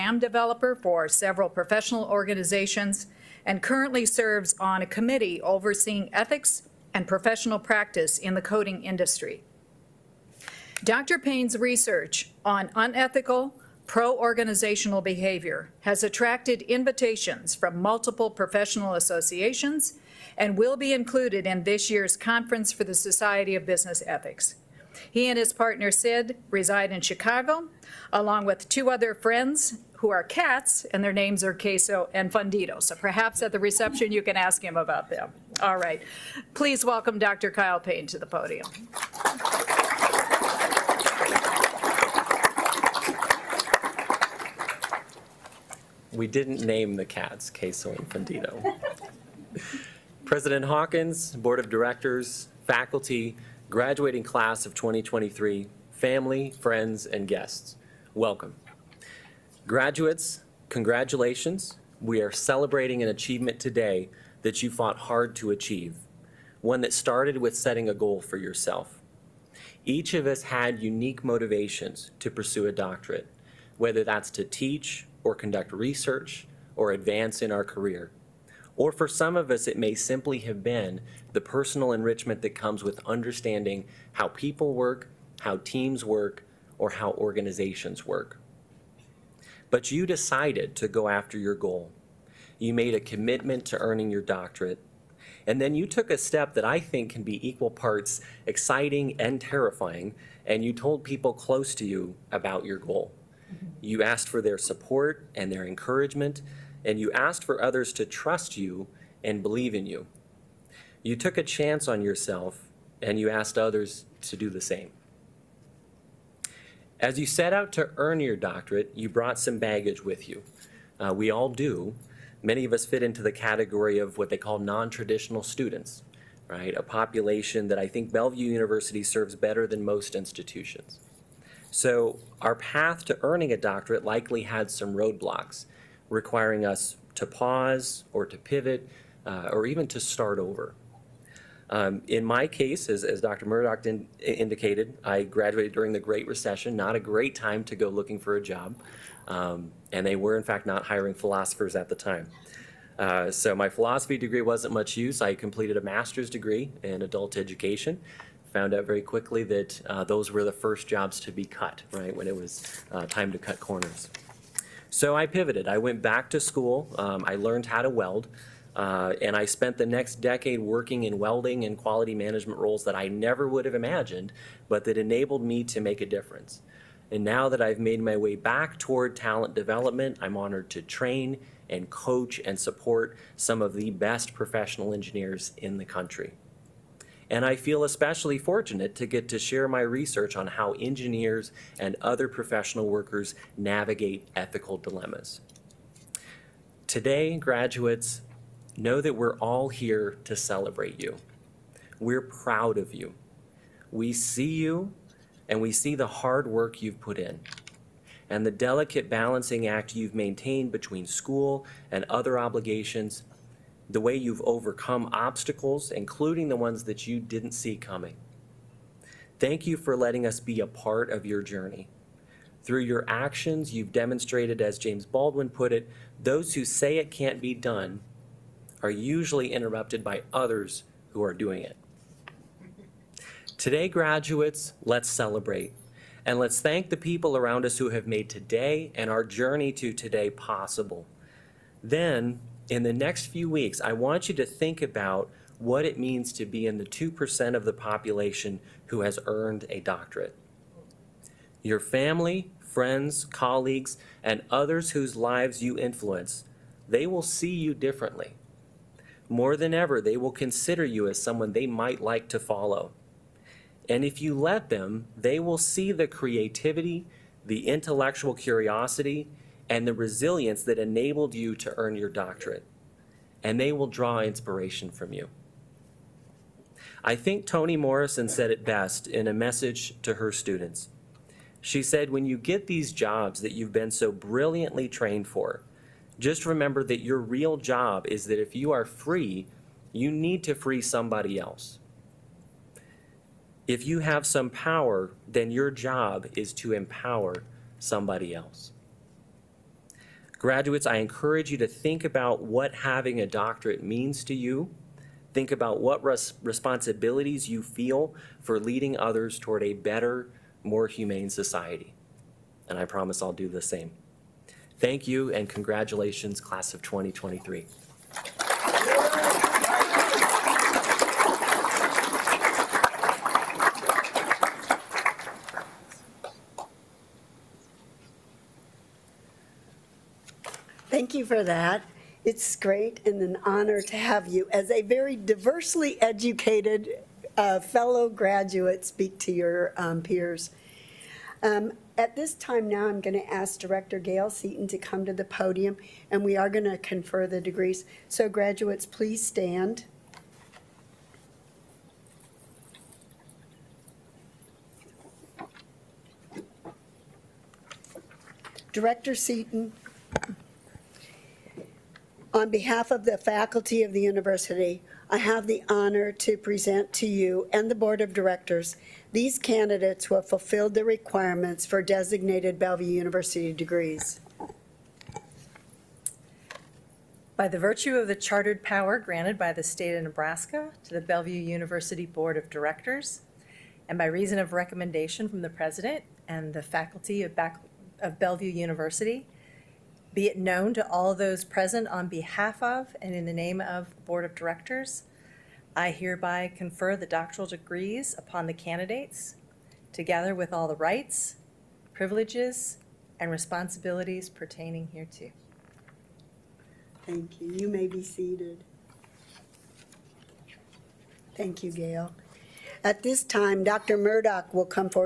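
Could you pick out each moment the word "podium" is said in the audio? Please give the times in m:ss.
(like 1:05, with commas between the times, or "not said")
0:38, 5:45.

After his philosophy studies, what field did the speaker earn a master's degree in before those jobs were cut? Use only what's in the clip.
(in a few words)
Adult education.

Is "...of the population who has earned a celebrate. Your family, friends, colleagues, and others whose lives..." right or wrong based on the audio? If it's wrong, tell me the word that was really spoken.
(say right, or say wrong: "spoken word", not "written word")
wrong: "doctorate", not "celebrate".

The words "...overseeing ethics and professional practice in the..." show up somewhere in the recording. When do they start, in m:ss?
0:05.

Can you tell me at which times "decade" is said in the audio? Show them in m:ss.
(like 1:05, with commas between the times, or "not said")
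2:50.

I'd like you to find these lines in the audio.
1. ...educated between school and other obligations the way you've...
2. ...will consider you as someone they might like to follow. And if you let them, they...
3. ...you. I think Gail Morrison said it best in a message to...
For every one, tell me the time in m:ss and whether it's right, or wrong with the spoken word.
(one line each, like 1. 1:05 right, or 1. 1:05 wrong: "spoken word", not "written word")
1. 3:30 wrong: "maintained", not "educated"
2. 4:20 right
3. 4:35 wrong: "Toni", not "Gail".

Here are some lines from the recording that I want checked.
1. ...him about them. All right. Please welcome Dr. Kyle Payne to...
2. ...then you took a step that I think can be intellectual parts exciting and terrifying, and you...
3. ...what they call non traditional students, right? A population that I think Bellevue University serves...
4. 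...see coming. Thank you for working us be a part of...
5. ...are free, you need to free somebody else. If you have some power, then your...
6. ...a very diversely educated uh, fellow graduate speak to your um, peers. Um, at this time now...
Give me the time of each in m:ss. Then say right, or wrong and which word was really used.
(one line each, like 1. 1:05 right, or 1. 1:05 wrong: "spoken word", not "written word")
1. 0:34 right
2. 1:35 wrong: "equal", not "intellectual"
3. 2:04 right
4. 3:37 wrong: "letting", not "working"
5. 4:48 right
6. 5:34 right.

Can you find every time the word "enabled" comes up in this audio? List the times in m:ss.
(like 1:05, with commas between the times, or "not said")
2:54, 4:30.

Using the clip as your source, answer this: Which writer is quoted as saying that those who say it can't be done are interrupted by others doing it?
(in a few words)
James Baldwin.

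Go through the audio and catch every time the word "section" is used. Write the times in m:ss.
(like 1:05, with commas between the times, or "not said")
not said.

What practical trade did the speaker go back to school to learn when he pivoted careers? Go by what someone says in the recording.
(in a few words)
Welding.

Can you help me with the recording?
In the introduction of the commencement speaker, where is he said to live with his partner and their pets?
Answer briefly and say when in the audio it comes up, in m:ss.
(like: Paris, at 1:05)
Chicago, at 0:27.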